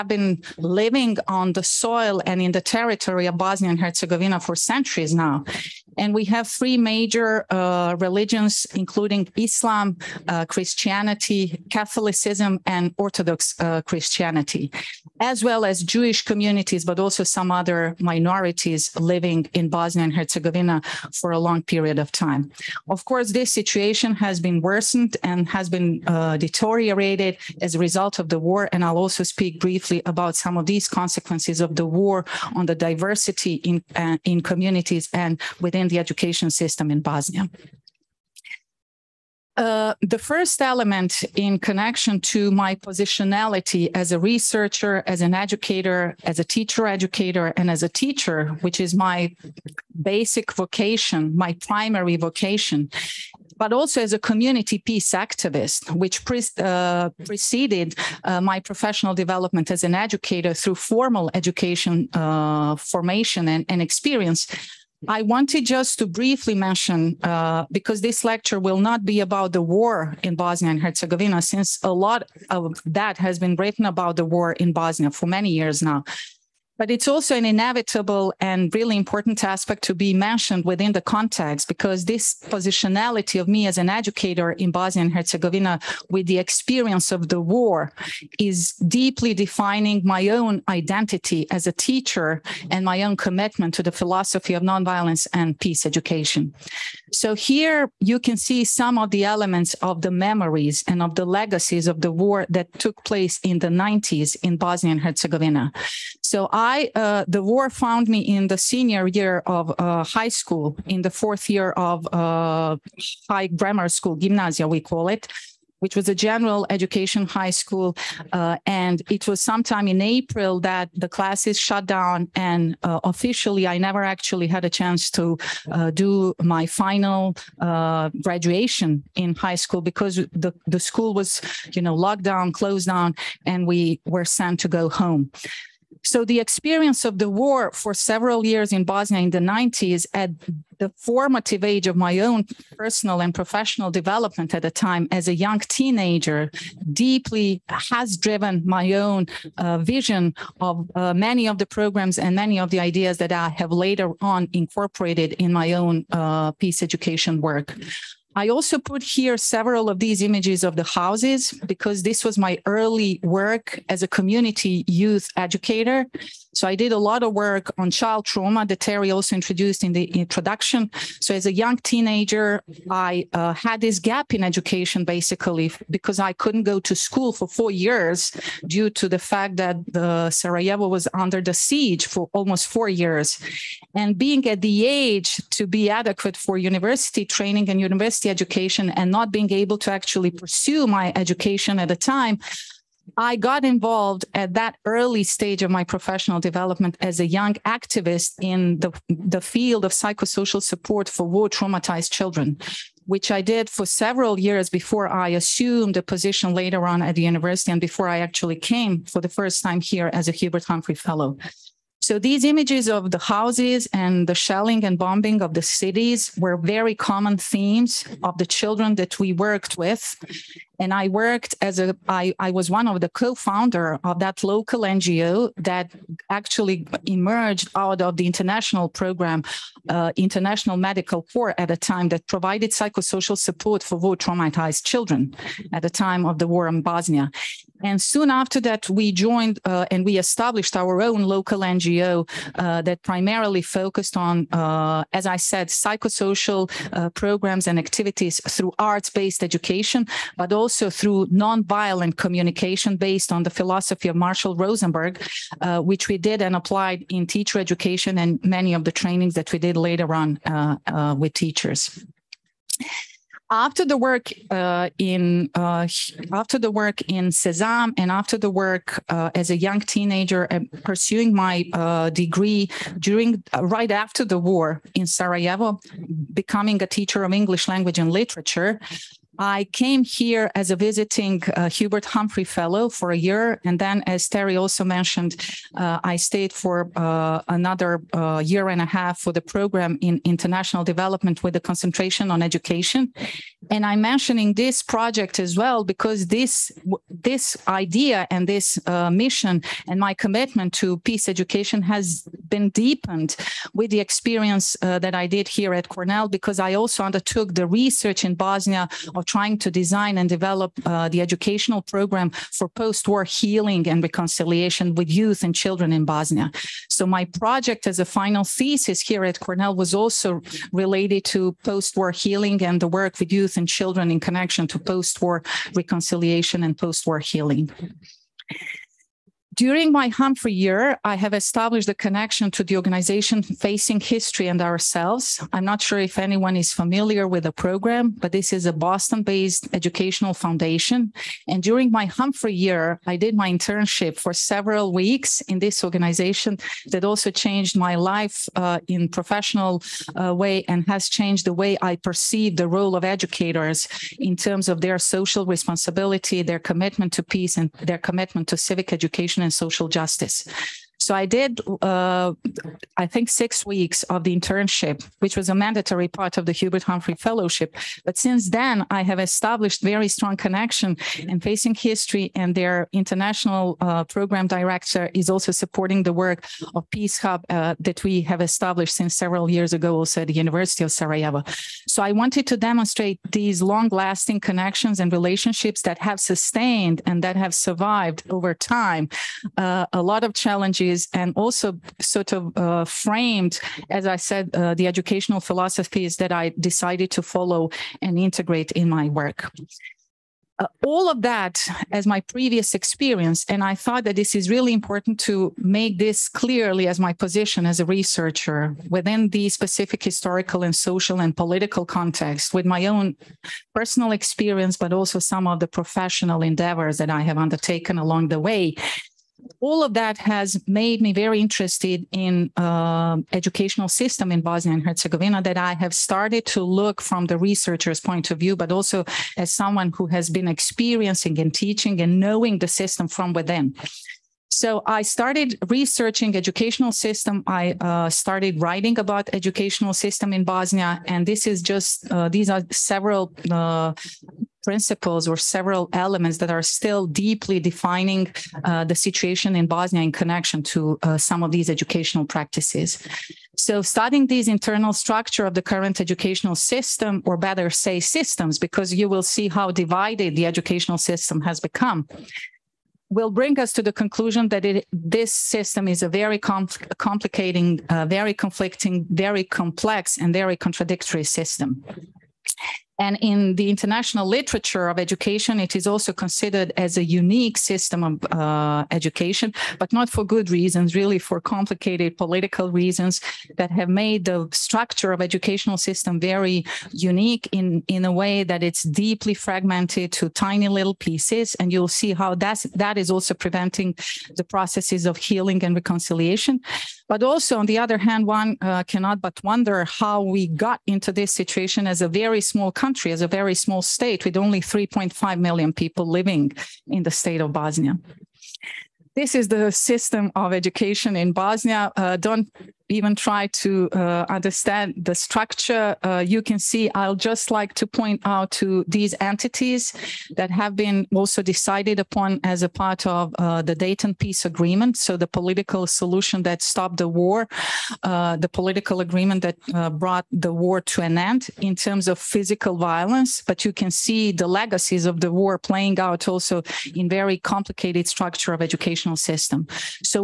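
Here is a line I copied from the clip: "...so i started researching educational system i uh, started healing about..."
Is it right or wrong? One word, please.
wrong.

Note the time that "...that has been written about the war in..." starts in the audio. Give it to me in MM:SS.
01:12.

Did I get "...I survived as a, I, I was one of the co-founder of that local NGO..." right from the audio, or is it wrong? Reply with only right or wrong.
wrong.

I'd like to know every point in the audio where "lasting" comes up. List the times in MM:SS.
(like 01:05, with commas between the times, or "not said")
06:23.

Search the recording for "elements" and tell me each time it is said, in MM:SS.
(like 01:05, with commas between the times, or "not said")
00:40, 01:39, 07:25.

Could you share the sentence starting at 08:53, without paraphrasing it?
But you can see the legacies of the war playing out also in very complicated structure of educational system.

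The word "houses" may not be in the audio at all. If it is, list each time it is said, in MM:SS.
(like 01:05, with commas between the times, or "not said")
02:40, 03:33.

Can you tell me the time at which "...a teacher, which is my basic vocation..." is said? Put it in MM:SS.
00:47.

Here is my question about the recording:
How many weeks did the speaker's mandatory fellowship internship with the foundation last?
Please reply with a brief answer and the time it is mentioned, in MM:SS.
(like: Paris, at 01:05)
6, at 06:03.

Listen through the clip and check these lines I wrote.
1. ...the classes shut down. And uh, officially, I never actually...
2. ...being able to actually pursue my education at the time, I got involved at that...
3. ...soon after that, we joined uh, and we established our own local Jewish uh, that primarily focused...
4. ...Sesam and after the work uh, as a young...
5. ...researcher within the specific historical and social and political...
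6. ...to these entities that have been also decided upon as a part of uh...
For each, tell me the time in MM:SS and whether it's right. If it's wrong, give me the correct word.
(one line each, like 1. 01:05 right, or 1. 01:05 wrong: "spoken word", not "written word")
1. 02:00 right
2. 03:09 right
3. 03:58 wrong: "NGO", not "Jewish"
4. 04:27 right
5. 06:47 right
6. 08:38 right.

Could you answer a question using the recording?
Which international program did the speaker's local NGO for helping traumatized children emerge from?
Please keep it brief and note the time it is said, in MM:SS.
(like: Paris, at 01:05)
International Medical Corps, at 03:50.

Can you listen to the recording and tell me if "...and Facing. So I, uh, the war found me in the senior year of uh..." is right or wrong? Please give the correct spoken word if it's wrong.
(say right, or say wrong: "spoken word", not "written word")
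wrong: "Herzegovina", not "Facing".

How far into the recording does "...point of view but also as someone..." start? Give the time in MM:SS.
07:08.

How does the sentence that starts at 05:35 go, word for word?
I'm not sure if anyone is familiar with the program, but this is a Boston based educational foundation.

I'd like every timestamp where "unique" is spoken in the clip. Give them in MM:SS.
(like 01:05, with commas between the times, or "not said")
07:57, 08:06.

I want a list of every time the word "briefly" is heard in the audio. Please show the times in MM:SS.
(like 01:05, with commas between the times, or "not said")
00:29, 01:06.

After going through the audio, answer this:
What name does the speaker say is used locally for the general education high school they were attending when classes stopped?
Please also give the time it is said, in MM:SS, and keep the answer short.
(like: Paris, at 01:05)
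gymnasia, at 01:54.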